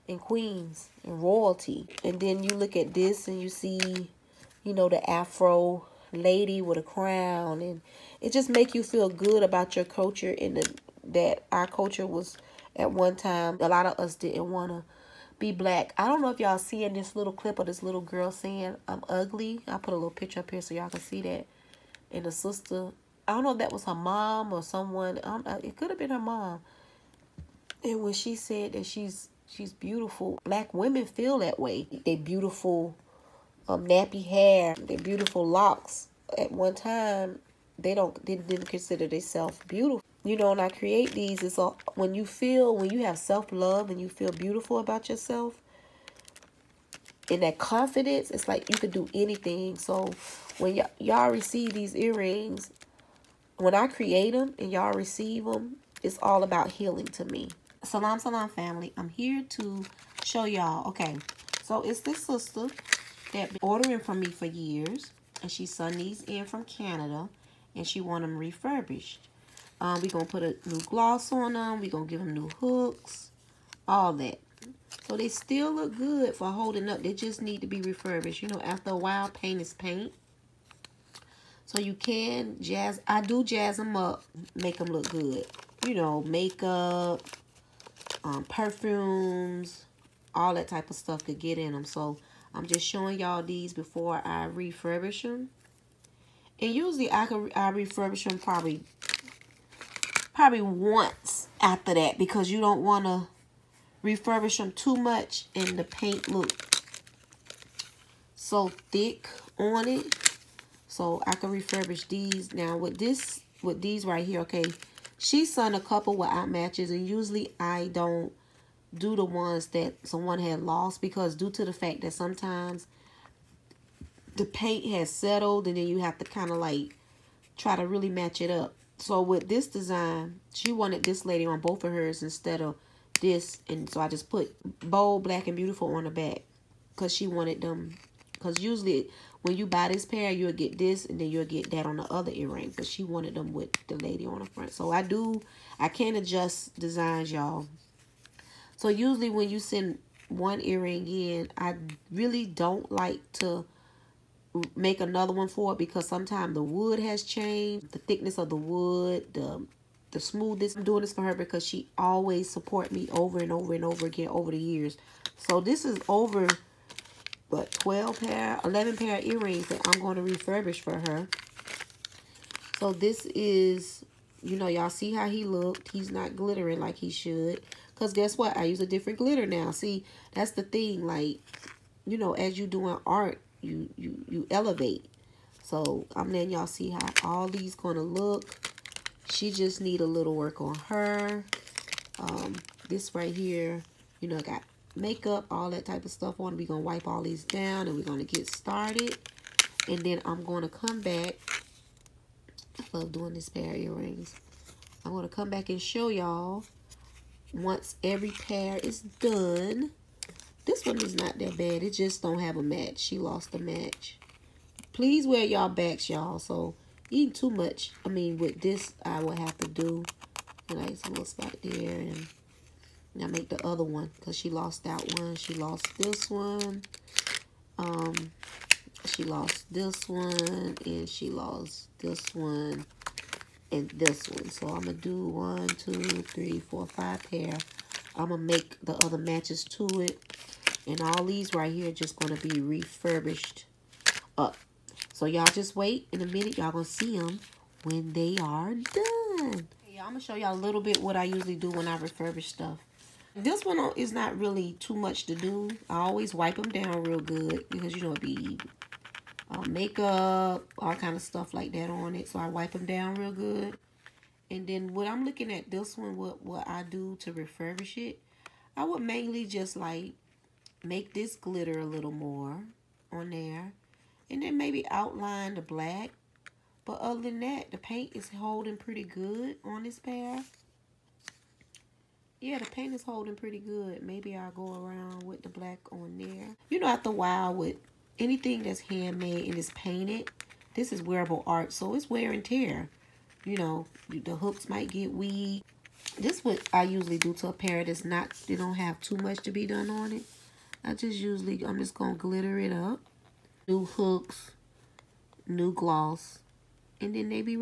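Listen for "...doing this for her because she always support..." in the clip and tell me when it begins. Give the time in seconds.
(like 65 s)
160 s.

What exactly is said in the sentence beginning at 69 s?
Um, we going to put a new gloss on them.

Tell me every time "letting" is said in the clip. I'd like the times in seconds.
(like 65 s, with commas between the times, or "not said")
186 s.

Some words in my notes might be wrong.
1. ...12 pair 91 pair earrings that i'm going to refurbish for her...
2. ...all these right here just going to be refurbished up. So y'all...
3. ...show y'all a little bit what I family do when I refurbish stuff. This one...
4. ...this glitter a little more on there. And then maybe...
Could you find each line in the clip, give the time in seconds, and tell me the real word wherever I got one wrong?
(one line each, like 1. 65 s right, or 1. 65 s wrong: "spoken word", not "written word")
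1. 167 s wrong: "11", not "91"
2. 240 s right
3. 250 s wrong: "usually", not "family"
4. 271 s right.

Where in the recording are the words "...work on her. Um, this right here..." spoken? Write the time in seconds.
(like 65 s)
190 s.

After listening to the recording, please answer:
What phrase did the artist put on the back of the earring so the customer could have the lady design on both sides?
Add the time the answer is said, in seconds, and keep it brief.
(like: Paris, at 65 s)
Bold, black, and beautiful, at 134 s.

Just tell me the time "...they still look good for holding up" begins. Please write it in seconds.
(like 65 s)
75 s.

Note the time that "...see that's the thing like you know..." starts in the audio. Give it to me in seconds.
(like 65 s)
179 s.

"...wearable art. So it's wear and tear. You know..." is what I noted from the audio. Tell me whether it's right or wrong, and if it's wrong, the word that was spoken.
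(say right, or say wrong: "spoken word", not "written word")
right.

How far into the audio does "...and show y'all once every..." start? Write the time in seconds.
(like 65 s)
205 s.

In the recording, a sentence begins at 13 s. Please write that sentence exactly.
A lot of us didn't want to be black.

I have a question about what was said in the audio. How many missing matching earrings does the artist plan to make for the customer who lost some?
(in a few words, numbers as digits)
5.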